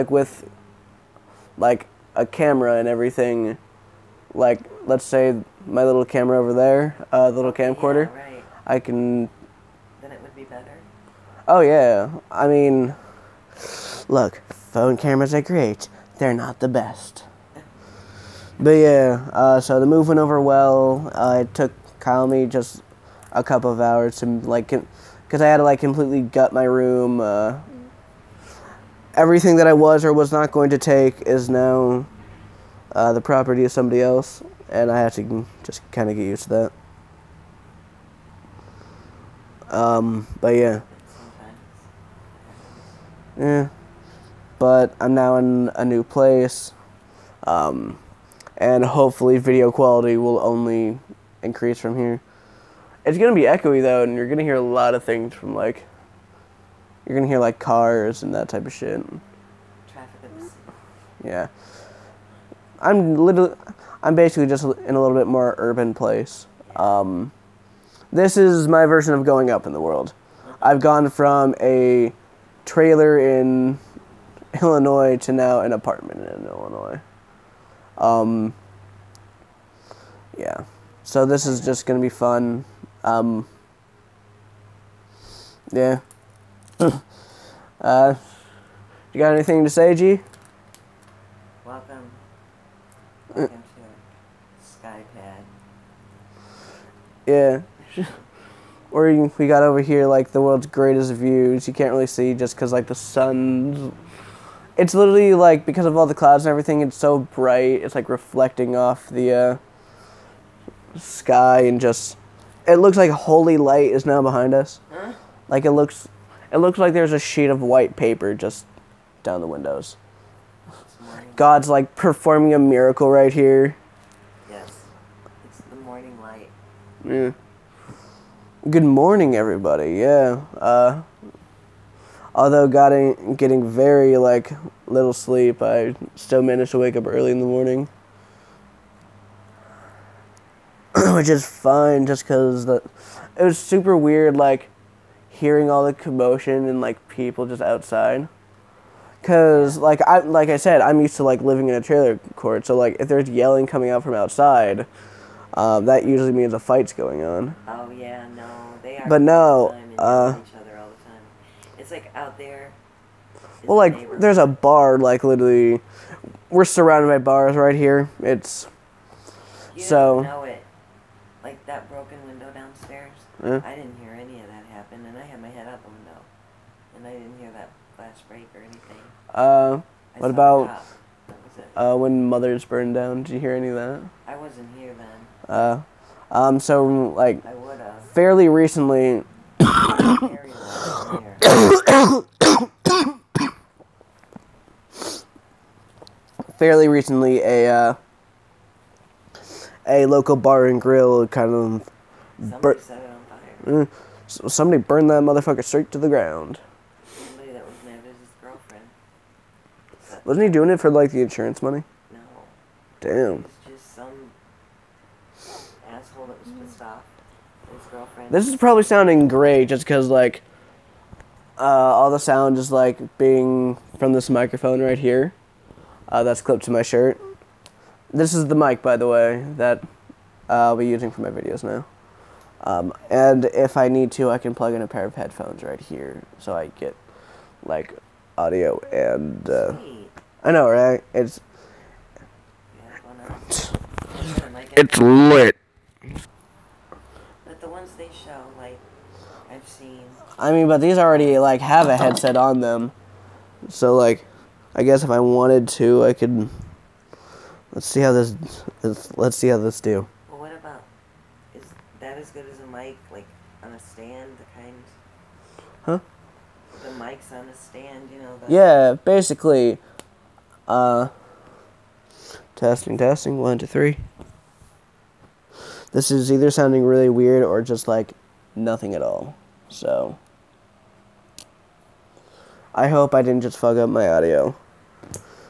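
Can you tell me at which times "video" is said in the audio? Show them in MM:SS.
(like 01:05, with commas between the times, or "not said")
00:49, 03:51.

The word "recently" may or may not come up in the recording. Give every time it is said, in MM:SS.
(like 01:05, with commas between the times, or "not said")
03:08, 03:16.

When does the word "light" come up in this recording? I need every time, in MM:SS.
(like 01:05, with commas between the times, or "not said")
01:53, 02:06.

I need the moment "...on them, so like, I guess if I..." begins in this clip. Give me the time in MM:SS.
04:12.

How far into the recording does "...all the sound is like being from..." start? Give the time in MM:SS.
03:41.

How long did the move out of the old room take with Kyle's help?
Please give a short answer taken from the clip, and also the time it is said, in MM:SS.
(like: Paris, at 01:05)
A couple, at 00:23.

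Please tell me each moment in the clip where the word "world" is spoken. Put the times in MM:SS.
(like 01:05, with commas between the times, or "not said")
01:09, 01:40.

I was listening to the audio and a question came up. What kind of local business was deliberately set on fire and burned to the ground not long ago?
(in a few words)
Bar and grill.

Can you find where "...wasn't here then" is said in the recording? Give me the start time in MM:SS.
03:04.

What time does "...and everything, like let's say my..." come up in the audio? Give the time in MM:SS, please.
00:02.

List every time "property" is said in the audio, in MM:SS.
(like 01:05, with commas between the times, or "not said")
00:33.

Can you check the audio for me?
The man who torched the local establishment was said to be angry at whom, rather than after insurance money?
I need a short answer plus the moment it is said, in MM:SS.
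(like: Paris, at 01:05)
His girlfriend, at 03:37.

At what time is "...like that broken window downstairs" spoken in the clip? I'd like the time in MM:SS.
02:51.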